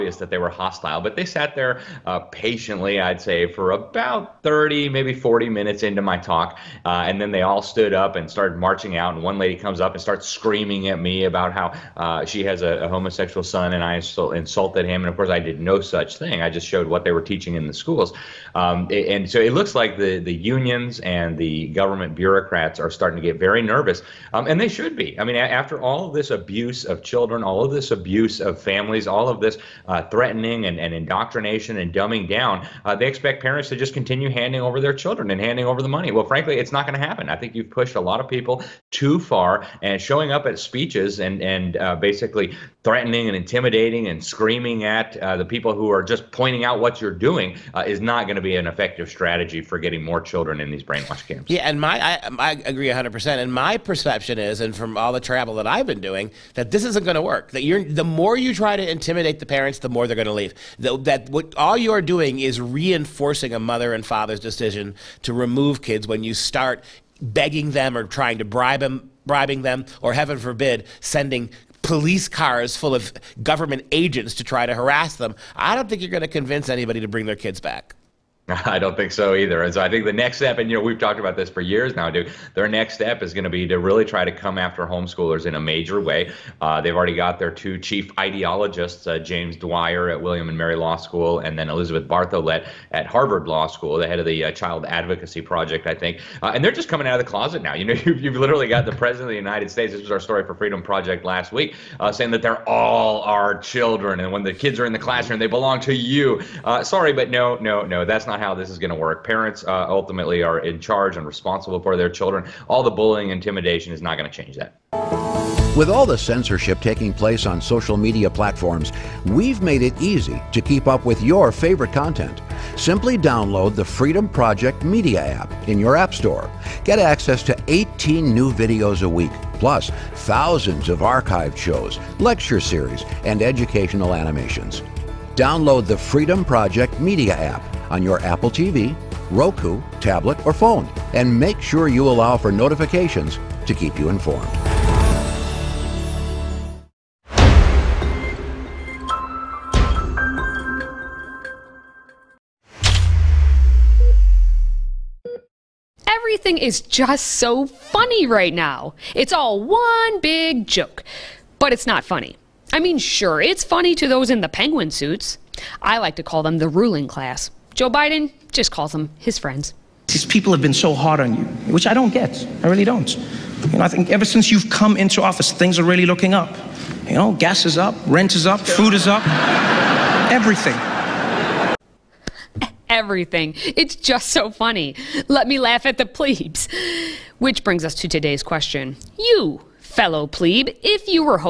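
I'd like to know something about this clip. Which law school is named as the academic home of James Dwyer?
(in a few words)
William and Mary Law School.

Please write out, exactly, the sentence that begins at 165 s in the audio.
I like to call them the ruling class.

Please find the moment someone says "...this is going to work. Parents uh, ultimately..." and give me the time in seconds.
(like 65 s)
108 s.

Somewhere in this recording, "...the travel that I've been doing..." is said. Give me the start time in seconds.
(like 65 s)
55 s.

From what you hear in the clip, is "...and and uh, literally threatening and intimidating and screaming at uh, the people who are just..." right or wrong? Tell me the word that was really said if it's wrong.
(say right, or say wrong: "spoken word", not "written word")
wrong: "basically", not "literally".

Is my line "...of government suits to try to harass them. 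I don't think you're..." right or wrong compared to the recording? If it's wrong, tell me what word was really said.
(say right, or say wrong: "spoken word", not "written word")
wrong: "agents", not "suits".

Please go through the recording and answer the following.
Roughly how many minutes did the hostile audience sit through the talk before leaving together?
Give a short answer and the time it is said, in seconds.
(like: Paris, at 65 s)
30 to 40 minutes, at 4 s.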